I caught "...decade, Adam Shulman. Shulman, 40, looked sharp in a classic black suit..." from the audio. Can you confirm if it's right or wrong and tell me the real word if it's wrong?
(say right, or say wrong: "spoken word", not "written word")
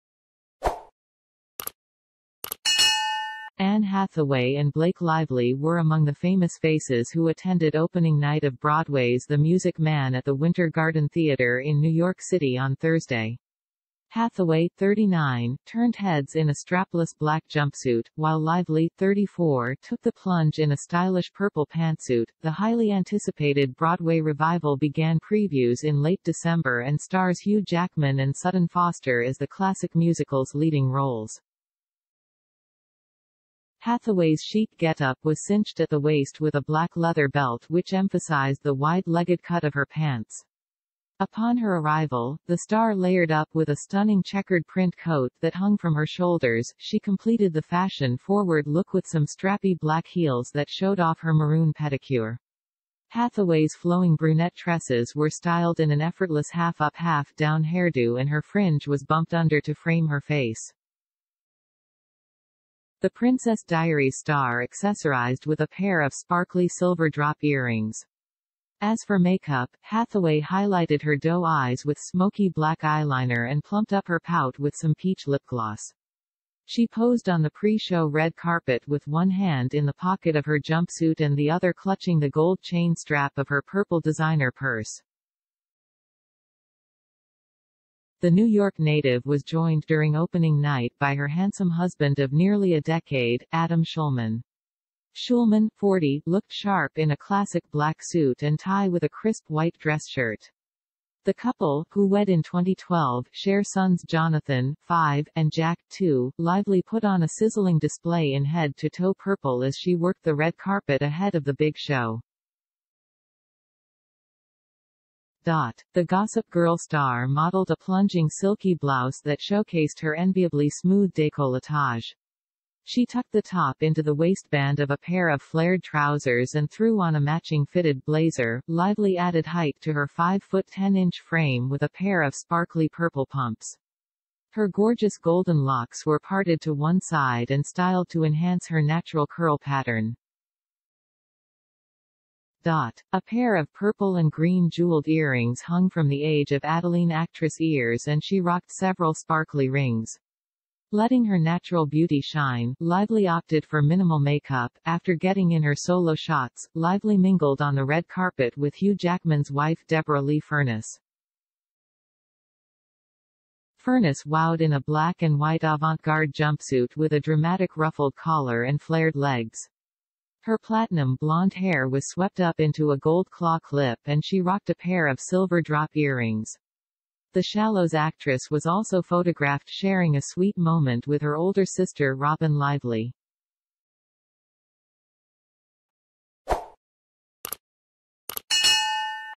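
right.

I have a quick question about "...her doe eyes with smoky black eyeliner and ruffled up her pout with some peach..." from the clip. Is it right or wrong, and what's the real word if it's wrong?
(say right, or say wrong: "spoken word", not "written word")
wrong: "plumped", not "ruffled".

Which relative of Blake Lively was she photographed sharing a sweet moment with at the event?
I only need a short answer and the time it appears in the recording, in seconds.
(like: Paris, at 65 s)
Robin Lively, at 182 s.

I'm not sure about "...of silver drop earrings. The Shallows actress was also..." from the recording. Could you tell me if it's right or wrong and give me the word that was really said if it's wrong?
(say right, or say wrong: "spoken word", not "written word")
right.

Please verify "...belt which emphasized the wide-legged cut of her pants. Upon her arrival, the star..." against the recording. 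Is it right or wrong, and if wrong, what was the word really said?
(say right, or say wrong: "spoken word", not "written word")
right.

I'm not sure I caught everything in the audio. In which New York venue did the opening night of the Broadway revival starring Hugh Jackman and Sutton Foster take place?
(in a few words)
Winter Garden Theater.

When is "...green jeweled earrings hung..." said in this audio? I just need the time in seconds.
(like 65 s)
144 s.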